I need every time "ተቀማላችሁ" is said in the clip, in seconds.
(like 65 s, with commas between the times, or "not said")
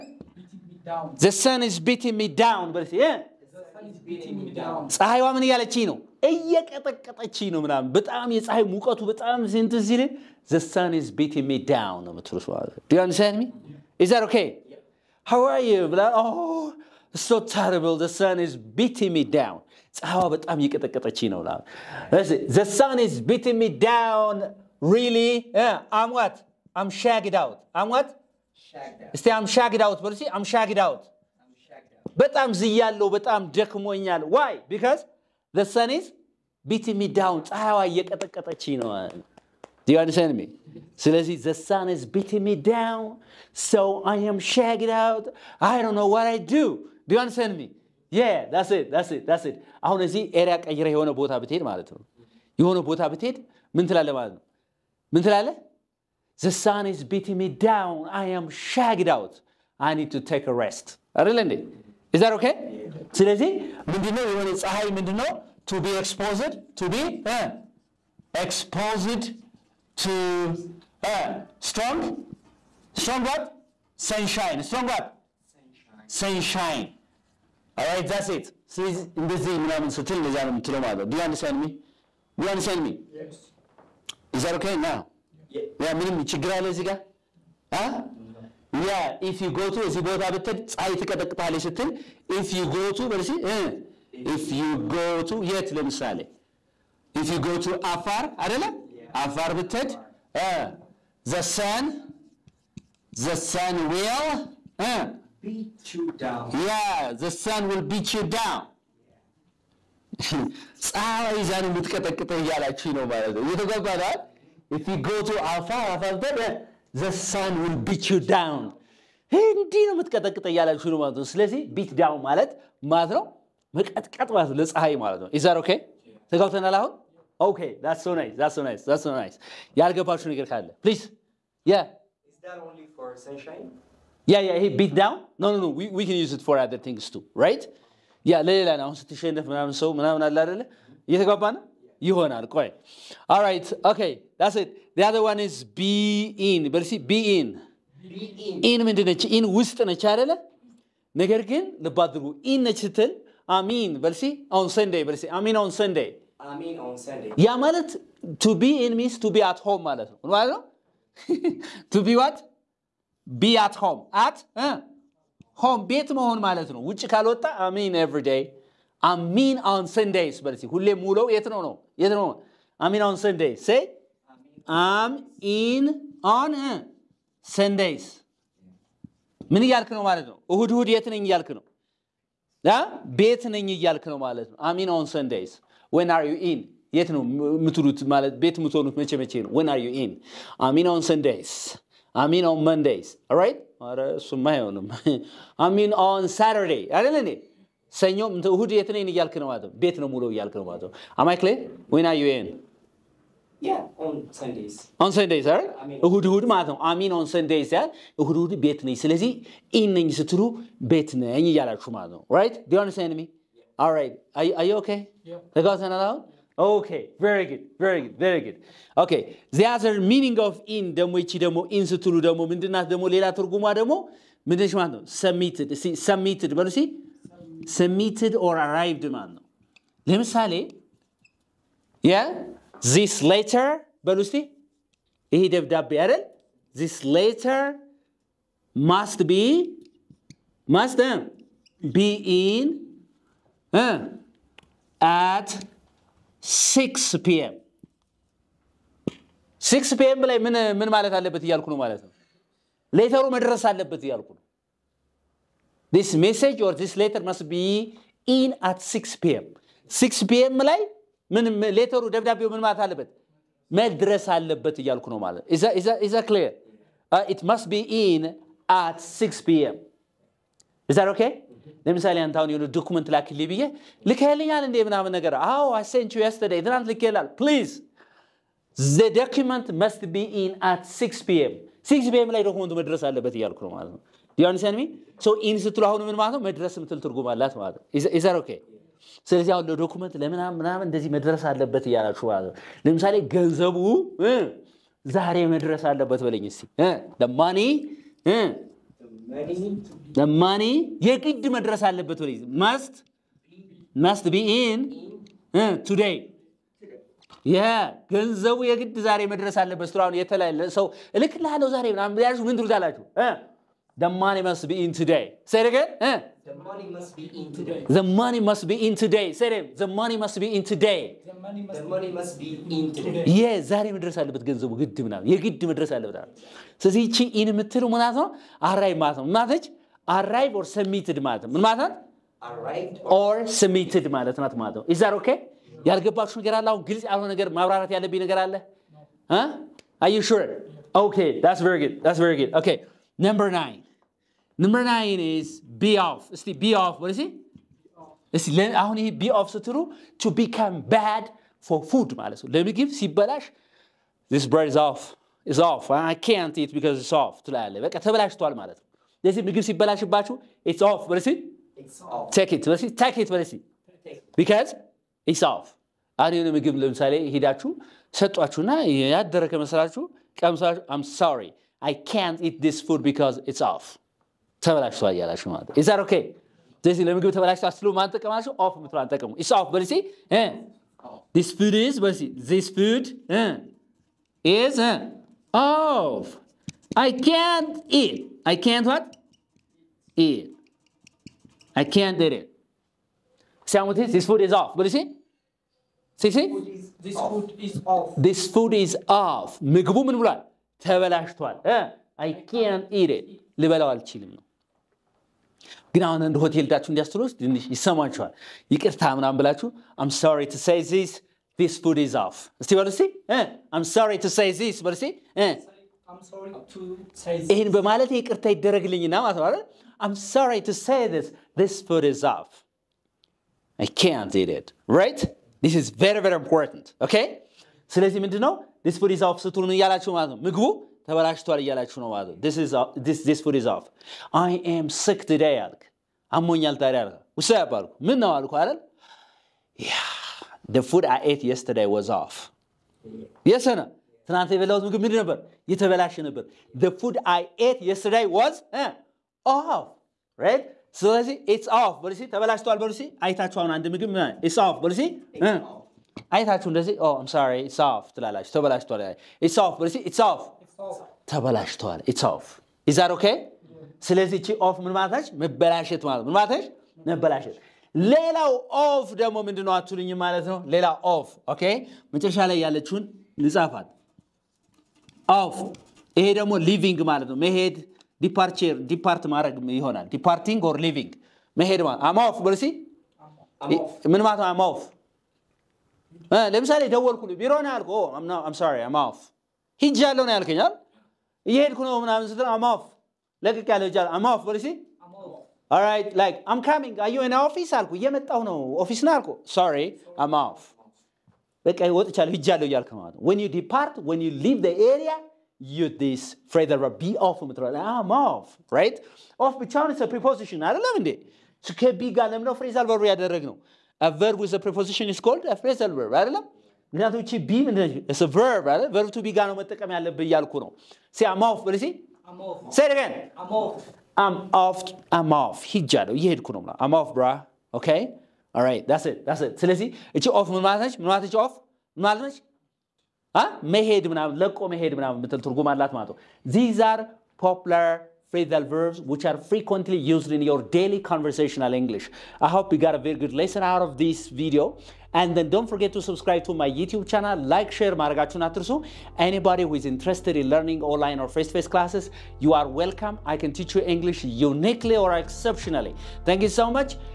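378 s.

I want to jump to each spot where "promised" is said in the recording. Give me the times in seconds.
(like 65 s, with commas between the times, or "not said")
not said.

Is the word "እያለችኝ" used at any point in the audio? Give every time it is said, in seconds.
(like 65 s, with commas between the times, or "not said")
5 s.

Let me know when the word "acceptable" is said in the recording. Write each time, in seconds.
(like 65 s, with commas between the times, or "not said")
not said.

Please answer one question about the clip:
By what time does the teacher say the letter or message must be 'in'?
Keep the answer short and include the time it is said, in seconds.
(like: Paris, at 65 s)
6 pm, at 255 s.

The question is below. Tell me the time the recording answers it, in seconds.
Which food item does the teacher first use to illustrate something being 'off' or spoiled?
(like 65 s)
354 s.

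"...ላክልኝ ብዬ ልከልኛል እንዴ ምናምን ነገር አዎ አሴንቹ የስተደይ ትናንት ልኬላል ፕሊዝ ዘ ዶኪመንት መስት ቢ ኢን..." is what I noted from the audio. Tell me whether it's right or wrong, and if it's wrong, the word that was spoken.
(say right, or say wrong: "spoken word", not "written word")
right.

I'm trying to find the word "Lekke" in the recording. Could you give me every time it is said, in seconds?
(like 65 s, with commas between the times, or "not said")
493 s, 501 s.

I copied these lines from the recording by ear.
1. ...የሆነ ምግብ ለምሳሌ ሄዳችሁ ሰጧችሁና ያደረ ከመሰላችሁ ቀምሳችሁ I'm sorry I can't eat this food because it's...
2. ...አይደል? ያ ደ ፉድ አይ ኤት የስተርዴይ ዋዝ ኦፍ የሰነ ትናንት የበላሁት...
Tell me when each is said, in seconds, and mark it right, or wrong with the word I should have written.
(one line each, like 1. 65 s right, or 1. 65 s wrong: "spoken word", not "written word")
1. 366 s right
2. 438 s right.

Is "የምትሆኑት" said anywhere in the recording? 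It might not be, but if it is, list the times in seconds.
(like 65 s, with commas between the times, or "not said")
188 s.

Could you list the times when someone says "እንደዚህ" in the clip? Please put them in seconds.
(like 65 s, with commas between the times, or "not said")
79 s, 290 s, 456 s.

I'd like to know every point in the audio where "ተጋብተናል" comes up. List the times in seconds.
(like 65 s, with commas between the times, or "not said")
126 s.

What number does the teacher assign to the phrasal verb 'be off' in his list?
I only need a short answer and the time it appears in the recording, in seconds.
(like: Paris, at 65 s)
9, at 344 s.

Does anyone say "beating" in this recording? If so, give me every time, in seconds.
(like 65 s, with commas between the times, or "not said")
11 s, 18 s, 23 s, 42 s, 57 s.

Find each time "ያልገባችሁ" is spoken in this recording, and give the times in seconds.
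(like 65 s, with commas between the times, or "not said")
129 s, 335 s.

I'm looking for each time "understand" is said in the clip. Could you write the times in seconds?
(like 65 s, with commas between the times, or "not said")
13 s, 40 s, 47 s.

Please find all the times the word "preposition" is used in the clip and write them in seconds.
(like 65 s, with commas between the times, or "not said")
510 s, 514 s.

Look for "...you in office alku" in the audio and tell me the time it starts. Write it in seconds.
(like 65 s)
497 s.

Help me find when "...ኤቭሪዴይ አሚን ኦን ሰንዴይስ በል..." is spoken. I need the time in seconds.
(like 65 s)
168 s.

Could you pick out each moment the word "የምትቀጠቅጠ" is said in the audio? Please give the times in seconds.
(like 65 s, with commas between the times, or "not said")
111 s, 119 s.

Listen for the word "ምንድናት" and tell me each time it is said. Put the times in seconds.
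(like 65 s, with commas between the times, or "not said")
222 s.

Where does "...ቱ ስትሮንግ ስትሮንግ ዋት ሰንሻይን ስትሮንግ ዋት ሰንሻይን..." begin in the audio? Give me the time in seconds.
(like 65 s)
70 s.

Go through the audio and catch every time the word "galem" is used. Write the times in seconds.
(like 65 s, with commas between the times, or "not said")
512 s.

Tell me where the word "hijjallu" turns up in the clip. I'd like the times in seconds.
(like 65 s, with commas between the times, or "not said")
489 s, 502 s.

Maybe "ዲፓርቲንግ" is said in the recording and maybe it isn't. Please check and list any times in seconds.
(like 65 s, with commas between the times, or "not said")
480 s.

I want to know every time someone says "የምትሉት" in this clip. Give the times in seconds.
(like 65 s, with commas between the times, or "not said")
12 s, 187 s.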